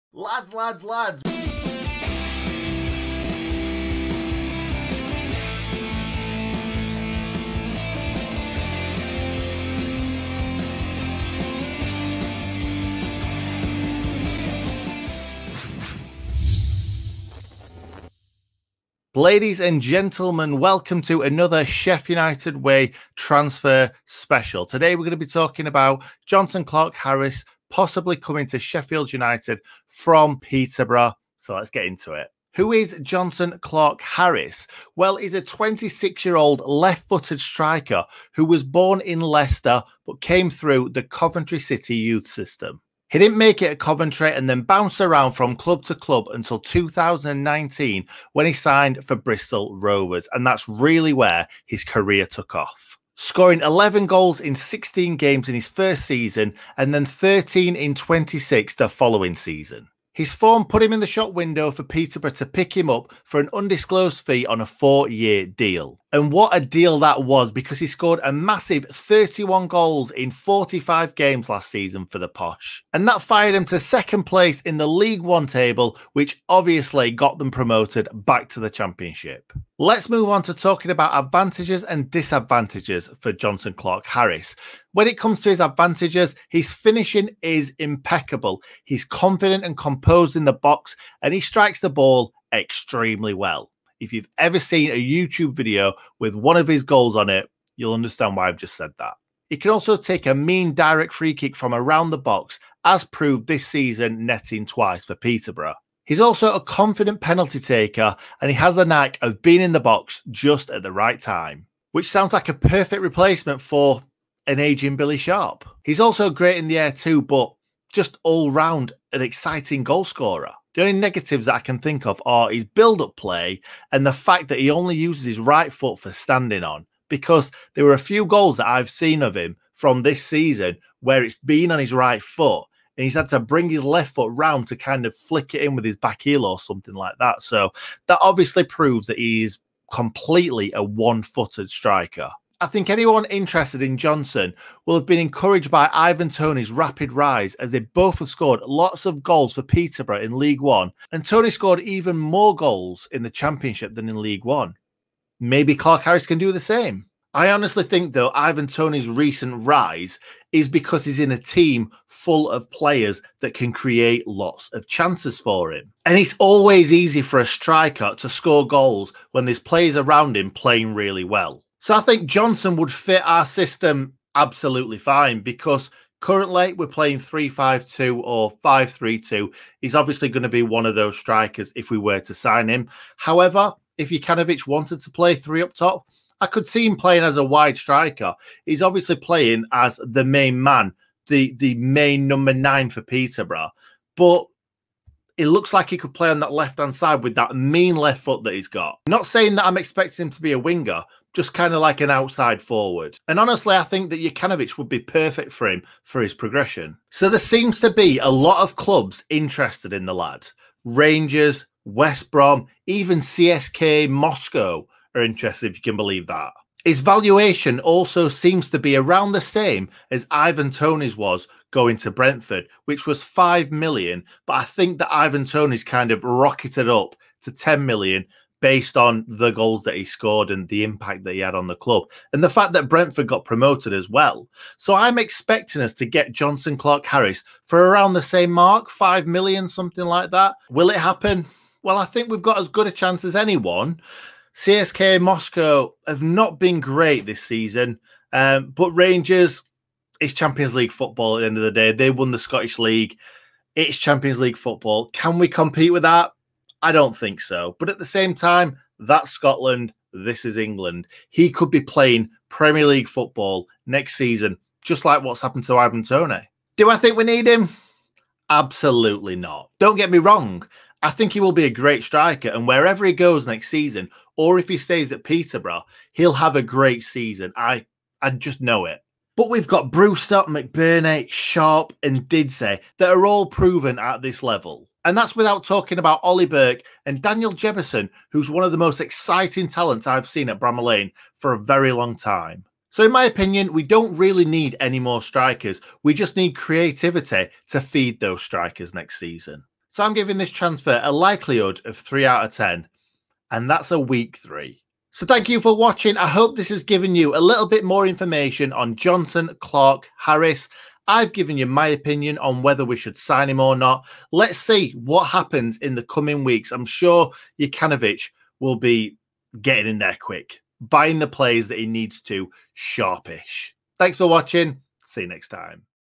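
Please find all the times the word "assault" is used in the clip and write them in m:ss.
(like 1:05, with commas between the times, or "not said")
not said.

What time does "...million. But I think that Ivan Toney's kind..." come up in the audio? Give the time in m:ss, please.
3:43.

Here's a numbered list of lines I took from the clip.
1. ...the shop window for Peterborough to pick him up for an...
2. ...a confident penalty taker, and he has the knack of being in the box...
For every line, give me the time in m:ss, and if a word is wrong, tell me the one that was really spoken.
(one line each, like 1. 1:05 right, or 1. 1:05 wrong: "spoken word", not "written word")
1. 1:00 right
2. 1:46 right.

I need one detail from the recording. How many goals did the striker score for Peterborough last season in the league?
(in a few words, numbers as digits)
31.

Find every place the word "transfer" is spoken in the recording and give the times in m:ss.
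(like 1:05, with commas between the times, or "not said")
0:23, 5:00.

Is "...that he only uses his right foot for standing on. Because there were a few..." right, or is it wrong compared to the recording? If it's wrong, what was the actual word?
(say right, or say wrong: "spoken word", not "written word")
right.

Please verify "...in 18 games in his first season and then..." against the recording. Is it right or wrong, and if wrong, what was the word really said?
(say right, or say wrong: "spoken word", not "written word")
wrong: "16", not "18".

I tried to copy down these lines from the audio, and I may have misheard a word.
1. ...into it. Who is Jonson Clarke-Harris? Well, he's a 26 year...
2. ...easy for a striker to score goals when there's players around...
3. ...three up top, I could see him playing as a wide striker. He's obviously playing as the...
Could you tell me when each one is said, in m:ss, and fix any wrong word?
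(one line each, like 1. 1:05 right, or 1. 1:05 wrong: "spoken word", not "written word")
1. 0:31 right
2. 2:46 right
3. 3:05 right.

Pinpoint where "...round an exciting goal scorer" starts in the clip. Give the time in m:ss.
1:58.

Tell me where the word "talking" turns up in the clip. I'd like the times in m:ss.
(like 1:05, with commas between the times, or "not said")
0:25, 1:20, 4:45.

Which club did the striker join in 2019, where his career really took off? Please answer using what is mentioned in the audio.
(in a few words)
Bristol Rovers.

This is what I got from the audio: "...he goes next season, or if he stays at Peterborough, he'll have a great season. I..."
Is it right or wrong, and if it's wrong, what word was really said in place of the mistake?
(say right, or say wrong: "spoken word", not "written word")
right.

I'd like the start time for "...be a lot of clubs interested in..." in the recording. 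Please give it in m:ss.
3:27.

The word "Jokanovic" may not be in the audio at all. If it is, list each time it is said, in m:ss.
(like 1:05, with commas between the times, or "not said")
3:04, 3:24, 5:17.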